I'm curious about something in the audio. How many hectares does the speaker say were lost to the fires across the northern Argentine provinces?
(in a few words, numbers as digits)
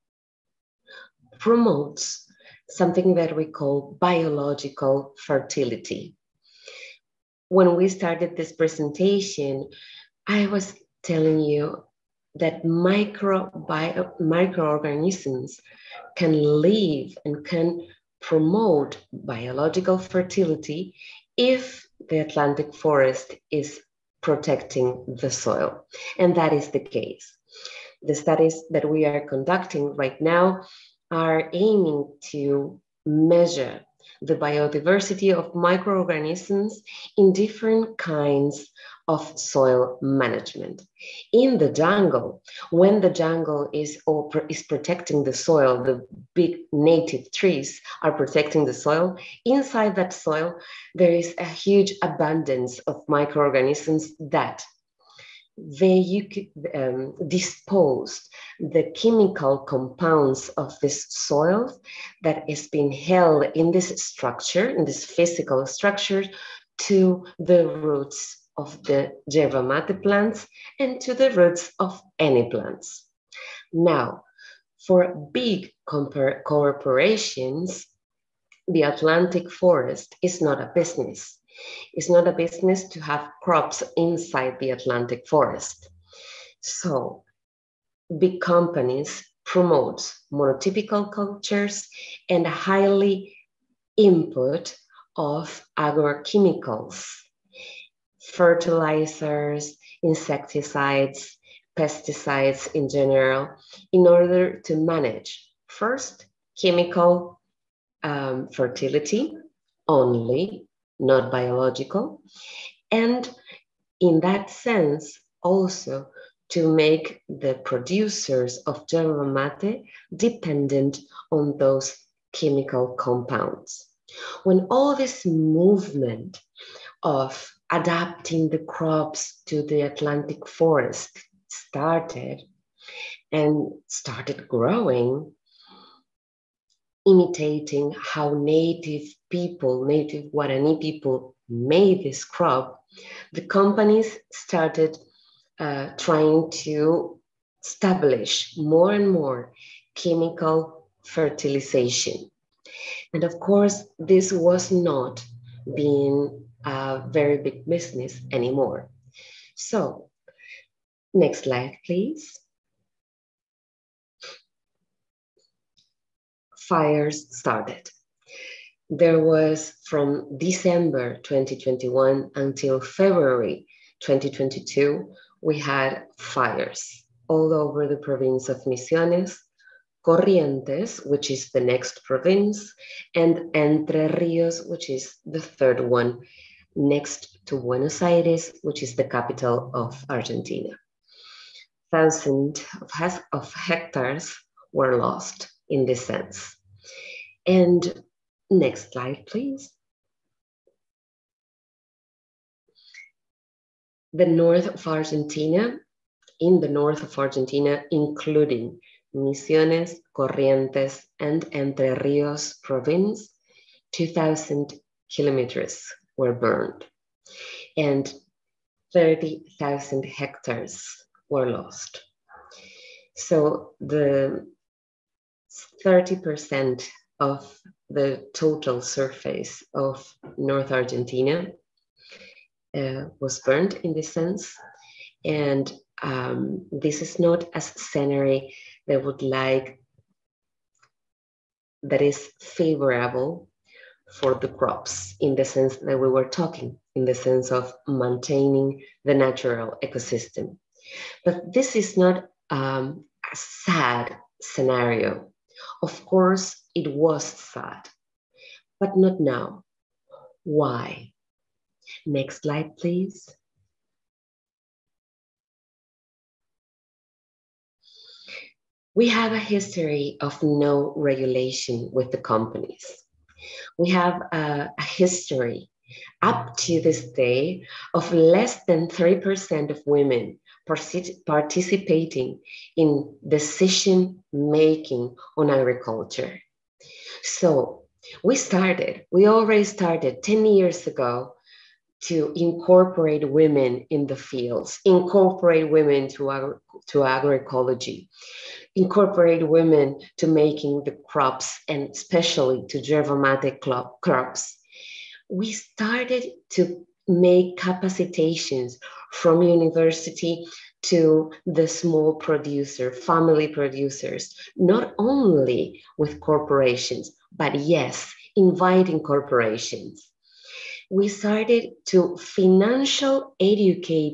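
30,000 hectares.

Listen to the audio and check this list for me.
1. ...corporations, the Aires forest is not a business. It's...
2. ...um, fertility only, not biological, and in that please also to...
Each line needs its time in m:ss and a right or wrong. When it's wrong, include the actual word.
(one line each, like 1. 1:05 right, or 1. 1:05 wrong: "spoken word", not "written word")
1. 1:15 wrong: "Atlantic", not "Aires"
2. 1:48 wrong: "sense", not "please".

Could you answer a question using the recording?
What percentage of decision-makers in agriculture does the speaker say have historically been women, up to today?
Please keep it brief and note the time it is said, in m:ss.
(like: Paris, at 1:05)
Less than 3%, at 4:38.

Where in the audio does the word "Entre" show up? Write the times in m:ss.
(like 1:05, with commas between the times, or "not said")
3:03, 3:31.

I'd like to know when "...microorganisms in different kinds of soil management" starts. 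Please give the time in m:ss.
0:35.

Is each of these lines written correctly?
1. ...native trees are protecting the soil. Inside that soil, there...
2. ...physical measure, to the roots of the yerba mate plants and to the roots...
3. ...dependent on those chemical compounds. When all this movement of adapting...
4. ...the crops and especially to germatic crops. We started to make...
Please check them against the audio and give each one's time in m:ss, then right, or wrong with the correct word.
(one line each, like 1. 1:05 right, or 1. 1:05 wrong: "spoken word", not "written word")
1. 0:46 right
2. 1:05 wrong: "structure", not "measure"
3. 2:00 right
4. 5:00 right.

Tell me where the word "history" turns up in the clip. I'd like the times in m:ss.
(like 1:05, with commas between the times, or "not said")
4:29, 4:34.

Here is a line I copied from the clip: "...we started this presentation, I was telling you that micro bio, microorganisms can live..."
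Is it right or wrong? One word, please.
right.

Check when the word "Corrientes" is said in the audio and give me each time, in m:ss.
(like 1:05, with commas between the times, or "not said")
3:00, 3:30.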